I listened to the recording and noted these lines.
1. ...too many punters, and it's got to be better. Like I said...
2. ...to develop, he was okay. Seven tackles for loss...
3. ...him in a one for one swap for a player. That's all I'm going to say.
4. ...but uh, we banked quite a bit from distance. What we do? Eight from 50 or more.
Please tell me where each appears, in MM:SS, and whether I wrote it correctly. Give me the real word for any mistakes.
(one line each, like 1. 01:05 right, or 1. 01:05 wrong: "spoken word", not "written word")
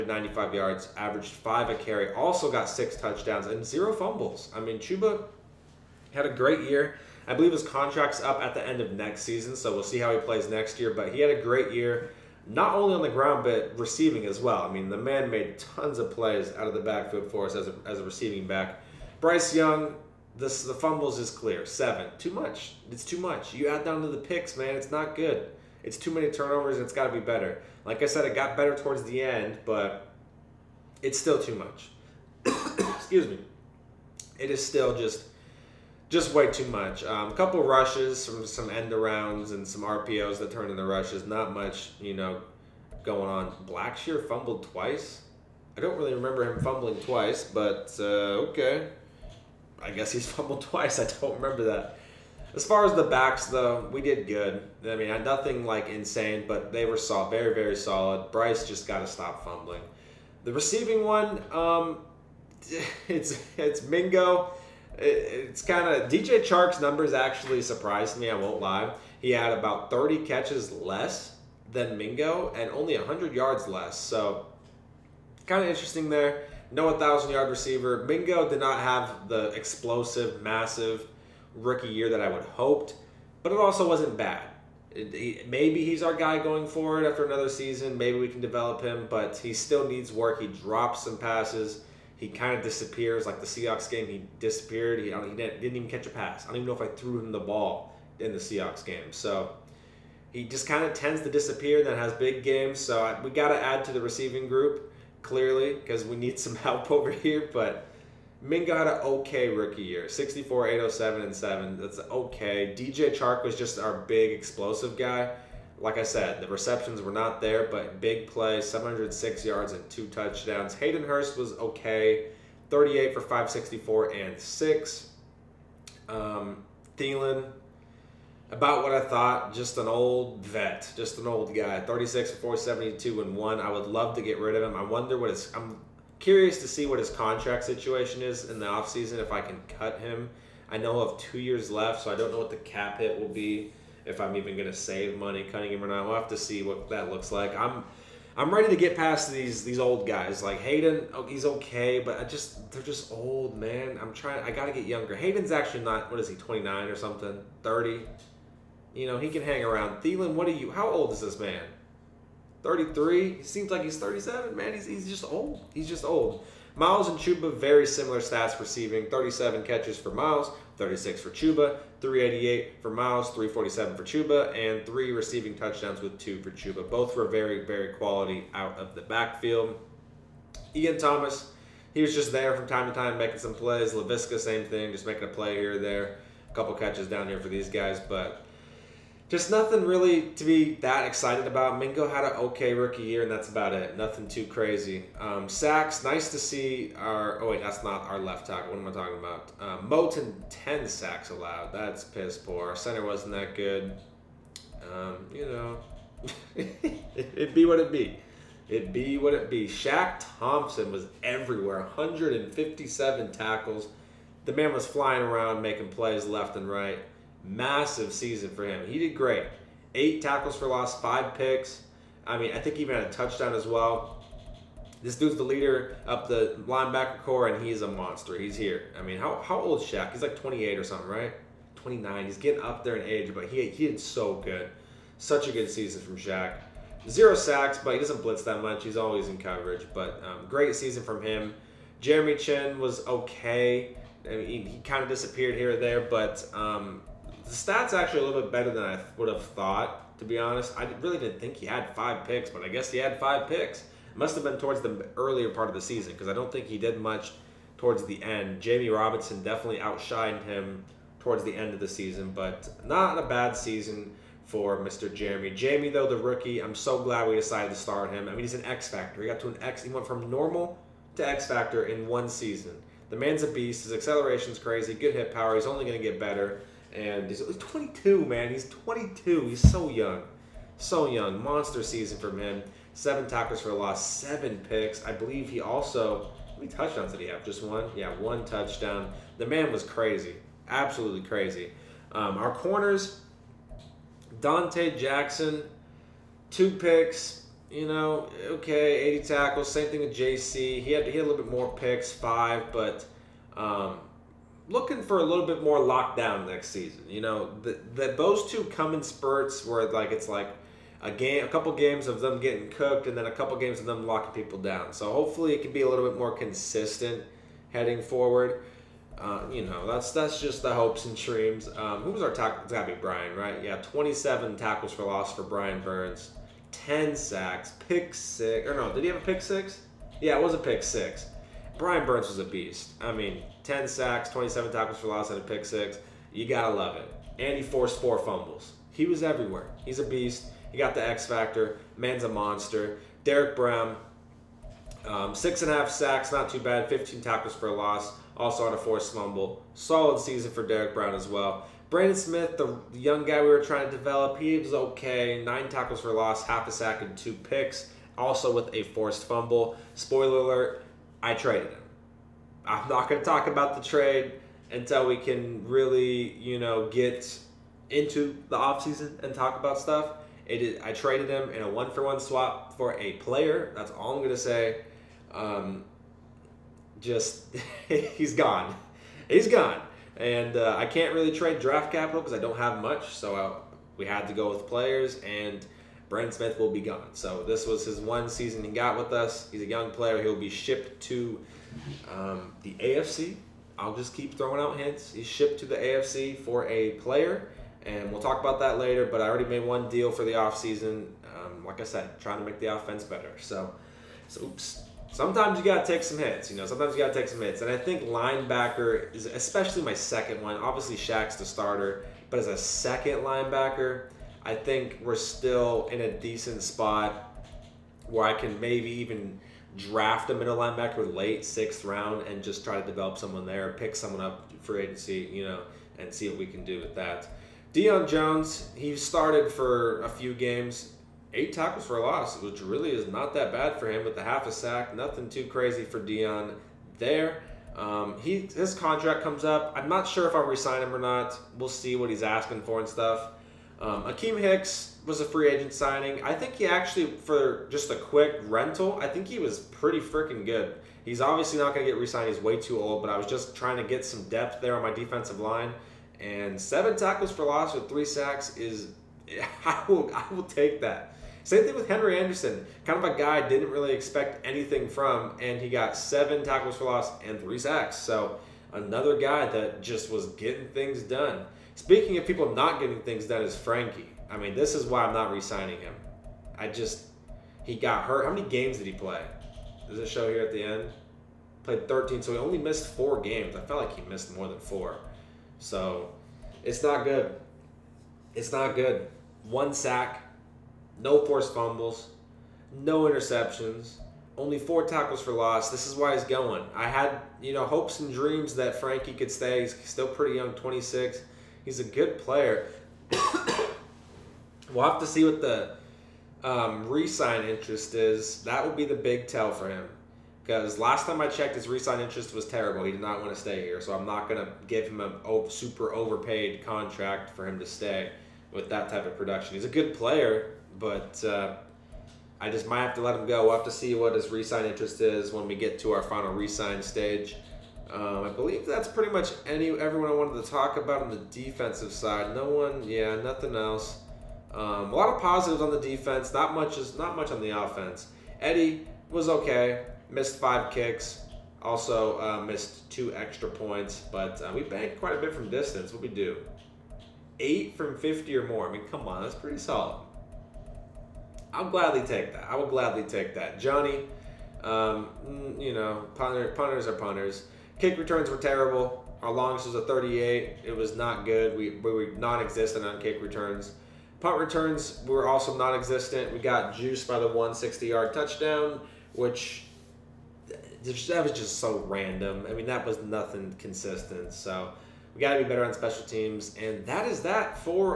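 1. 00:25 wrong: "turnovers", not "punters"
2. 05:53 wrong: "Nine", not "Seven"
3. 06:11 right
4. 09:04 right.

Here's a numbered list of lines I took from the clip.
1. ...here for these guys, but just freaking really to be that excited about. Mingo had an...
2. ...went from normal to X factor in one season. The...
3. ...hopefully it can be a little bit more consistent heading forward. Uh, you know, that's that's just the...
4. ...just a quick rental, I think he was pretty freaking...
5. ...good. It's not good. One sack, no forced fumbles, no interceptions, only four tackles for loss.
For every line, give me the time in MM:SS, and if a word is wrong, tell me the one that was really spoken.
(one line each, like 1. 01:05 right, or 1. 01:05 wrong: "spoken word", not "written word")
1. 03:07 wrong: "nothing", not "freaking"
2. 04:29 right
3. 05:15 right
4. 07:27 right
5. 08:07 right.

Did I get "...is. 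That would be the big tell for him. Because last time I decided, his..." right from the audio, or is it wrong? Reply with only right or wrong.
wrong.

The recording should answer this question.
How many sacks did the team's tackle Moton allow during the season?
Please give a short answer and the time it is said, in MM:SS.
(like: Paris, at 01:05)
10, at 03:20.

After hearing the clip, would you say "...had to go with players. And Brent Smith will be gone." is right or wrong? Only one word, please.
right.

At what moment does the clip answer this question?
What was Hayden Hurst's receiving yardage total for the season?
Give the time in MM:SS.
02:03.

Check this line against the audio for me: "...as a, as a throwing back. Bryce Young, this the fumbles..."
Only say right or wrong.
wrong.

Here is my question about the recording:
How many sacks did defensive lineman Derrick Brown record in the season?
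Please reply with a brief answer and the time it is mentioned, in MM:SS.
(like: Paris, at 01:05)
6.5, at 05:45.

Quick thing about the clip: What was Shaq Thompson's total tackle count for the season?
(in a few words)
157.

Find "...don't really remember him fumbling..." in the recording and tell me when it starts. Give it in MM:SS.
00:45.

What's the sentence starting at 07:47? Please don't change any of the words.
So another guy that just was getting things done.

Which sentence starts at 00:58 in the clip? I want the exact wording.
Bryce just got to stop fumbling.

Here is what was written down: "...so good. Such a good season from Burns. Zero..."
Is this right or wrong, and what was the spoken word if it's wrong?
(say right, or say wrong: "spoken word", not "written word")
wrong: "Shaq", not "Burns".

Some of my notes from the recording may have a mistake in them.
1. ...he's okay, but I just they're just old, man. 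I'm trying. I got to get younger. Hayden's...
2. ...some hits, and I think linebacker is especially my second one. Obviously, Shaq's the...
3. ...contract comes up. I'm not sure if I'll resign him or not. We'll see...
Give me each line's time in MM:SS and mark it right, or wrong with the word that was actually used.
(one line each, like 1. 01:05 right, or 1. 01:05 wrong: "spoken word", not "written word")
1. 02:31 right
2. 06:47 right
3. 07:18 right.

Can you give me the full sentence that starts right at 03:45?
This dude's the leader up the linebacker core, and he's a monster.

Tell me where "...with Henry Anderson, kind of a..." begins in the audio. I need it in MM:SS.
07:41.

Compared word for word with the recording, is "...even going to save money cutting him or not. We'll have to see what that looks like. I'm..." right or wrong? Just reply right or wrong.
right.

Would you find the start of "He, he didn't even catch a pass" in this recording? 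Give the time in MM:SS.
01:34.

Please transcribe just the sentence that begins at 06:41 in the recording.
Um, like I said, trying to make the offense better.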